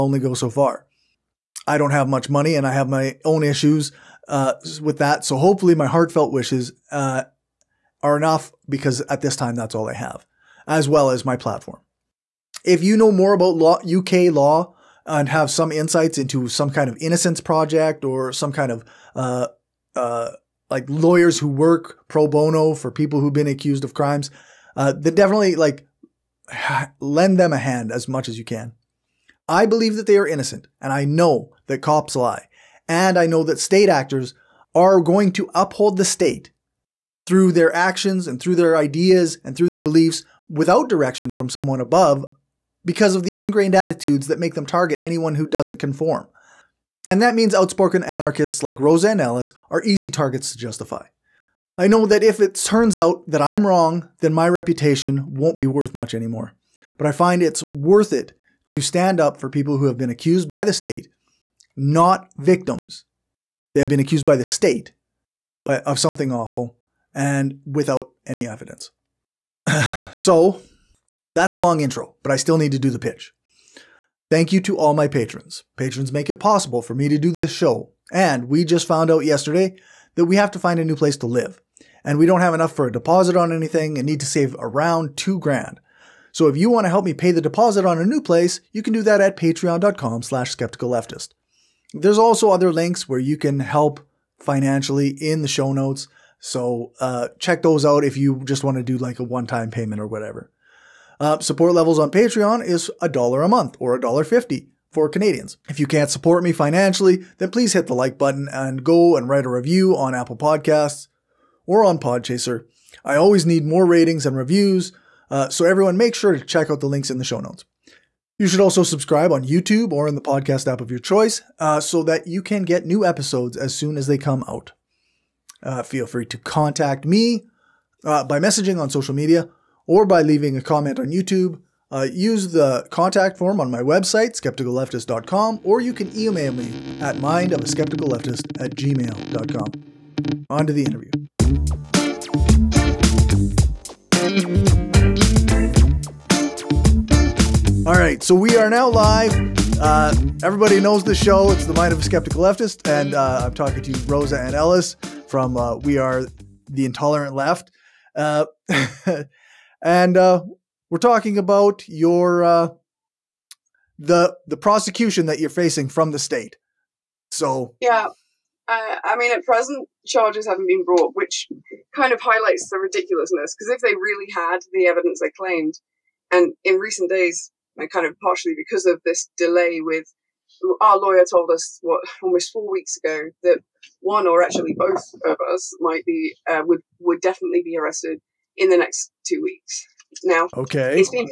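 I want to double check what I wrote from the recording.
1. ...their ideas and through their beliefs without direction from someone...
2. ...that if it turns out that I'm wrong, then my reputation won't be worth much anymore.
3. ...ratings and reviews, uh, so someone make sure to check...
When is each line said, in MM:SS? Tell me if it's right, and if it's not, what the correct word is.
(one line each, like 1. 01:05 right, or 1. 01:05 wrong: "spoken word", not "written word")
1. 00:38 right
2. 00:52 right
3. 01:53 wrong: "everyone", not "someone".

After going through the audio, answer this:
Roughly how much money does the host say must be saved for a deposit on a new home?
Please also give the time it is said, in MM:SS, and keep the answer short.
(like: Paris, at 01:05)
2 grand, at 01:25.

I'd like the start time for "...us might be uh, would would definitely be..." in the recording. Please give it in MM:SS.
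03:05.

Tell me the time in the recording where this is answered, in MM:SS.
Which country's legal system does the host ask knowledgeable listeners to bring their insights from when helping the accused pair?
00:13.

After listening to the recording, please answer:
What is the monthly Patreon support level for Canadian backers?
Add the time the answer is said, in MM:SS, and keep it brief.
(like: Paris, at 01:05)
a dollar fifty, at 01:43.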